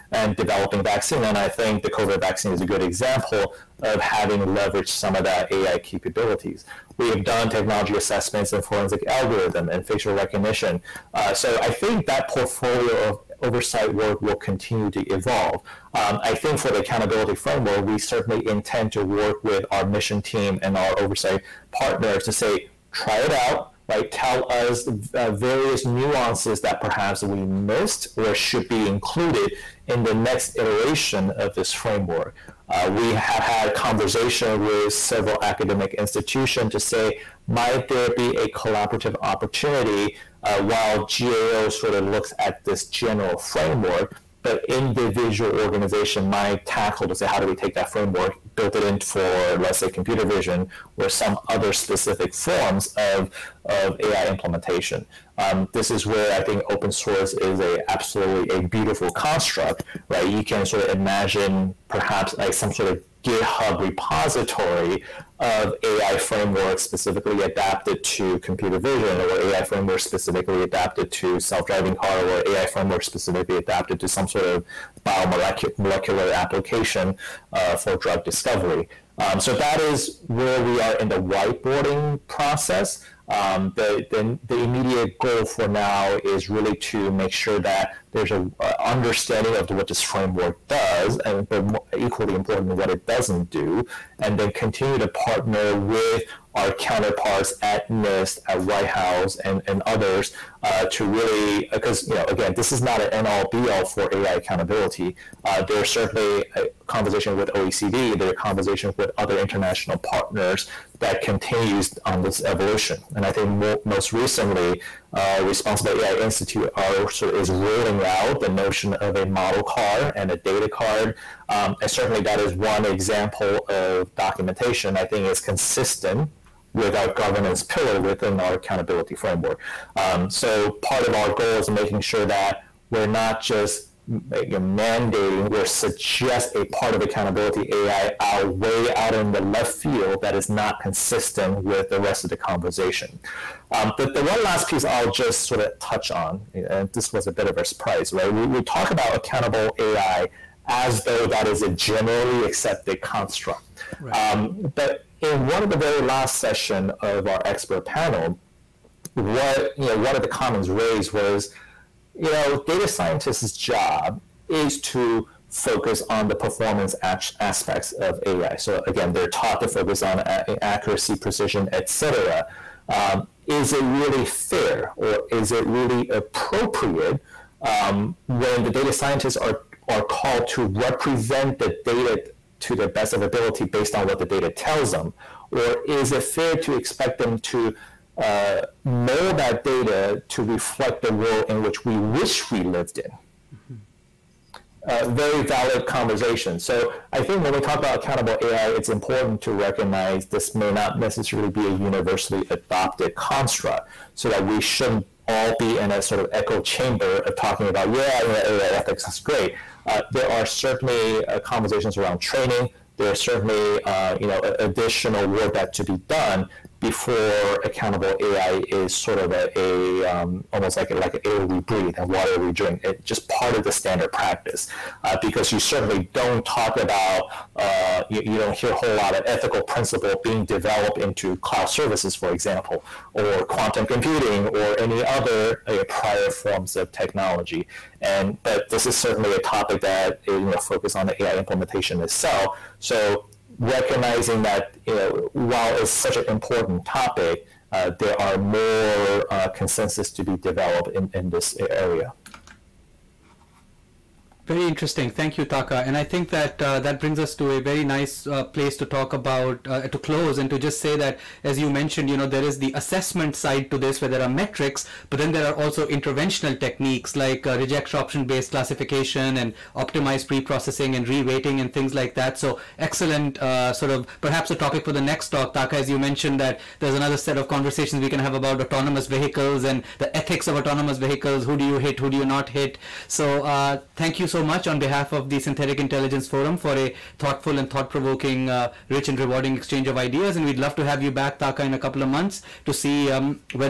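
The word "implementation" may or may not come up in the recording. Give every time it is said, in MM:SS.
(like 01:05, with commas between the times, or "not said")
00:54, 04:01.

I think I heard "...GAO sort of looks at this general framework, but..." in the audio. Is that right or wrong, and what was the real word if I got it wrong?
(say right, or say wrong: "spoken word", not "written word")
right.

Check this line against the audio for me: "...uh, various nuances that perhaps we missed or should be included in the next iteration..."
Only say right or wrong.
right.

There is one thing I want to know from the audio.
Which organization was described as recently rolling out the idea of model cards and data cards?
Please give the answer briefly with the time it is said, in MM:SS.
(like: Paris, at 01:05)
Responsible AI Institute, at 01:55.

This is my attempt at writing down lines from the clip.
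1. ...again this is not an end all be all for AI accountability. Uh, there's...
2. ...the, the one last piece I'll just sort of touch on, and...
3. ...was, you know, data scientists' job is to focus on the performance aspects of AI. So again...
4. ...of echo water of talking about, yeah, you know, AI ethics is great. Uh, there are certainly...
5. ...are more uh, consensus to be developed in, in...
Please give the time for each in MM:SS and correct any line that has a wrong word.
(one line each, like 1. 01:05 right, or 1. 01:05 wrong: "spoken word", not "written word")
1. 01:42 right
2. 02:23 right
3. 02:41 right
4. 03:26 wrong: "chamber", not "water"
5. 04:08 right.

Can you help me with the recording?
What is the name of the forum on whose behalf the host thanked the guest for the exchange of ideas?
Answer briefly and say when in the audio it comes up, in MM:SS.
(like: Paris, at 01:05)
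Synthetic Intelligence Forum, at 04:45.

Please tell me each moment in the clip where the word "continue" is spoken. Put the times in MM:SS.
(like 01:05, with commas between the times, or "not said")
00:14, 01:34, 01:51.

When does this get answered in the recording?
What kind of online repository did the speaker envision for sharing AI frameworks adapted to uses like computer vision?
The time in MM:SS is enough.
01:03.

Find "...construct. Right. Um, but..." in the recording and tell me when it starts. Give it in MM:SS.
02:33.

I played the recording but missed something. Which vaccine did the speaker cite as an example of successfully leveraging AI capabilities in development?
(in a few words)
COVID vaccine.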